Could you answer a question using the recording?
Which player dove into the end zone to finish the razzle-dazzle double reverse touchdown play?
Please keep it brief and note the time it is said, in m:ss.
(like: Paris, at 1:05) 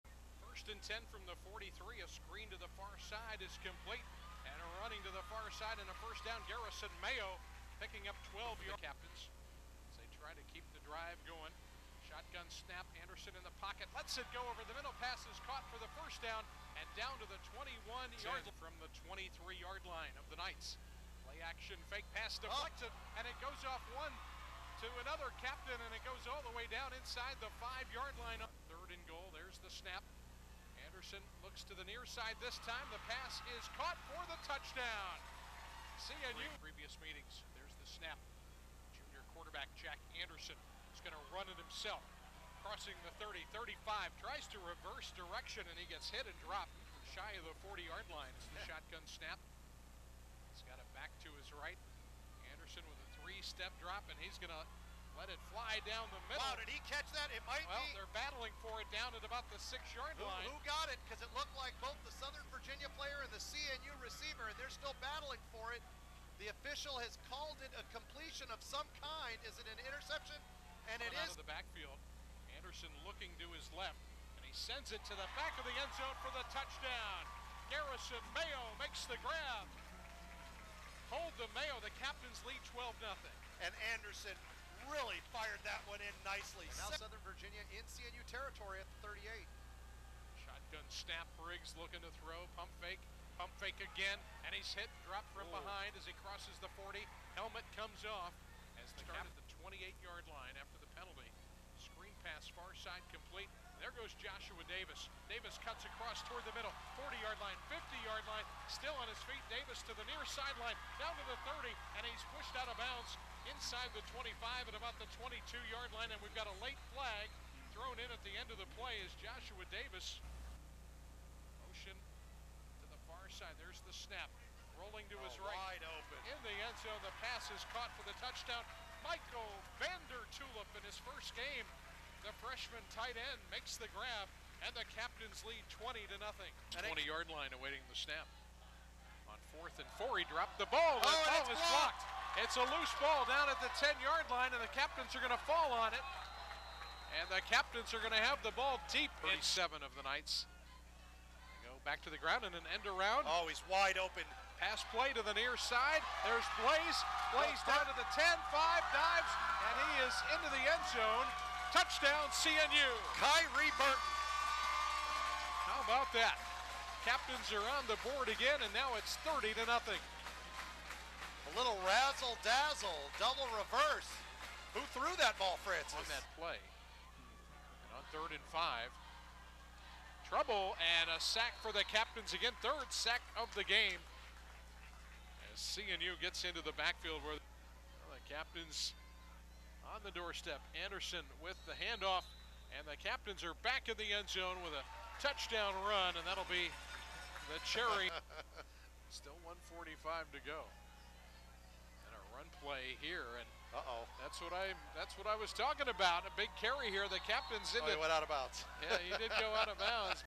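Kyrie Burton, at 2:43.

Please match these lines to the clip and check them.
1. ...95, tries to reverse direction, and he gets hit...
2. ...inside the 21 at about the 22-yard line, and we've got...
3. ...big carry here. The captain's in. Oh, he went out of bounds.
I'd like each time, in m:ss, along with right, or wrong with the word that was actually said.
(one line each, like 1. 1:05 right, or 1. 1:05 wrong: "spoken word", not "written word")
1. 0:43 wrong: "35", not "95"
2. 1:53 wrong: "25", not "21"
3. 3:26 right.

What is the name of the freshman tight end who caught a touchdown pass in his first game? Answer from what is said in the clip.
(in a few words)
Michael Vander Tulip.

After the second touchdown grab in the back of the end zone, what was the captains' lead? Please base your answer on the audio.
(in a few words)
12-0.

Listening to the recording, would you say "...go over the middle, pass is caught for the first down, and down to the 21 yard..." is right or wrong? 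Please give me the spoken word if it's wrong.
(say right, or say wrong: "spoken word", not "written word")
right.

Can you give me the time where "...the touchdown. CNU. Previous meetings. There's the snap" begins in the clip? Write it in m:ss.
0:34.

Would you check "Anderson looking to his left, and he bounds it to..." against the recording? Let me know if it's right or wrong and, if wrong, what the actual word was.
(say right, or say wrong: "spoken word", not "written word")
wrong: "sends", not "bounds".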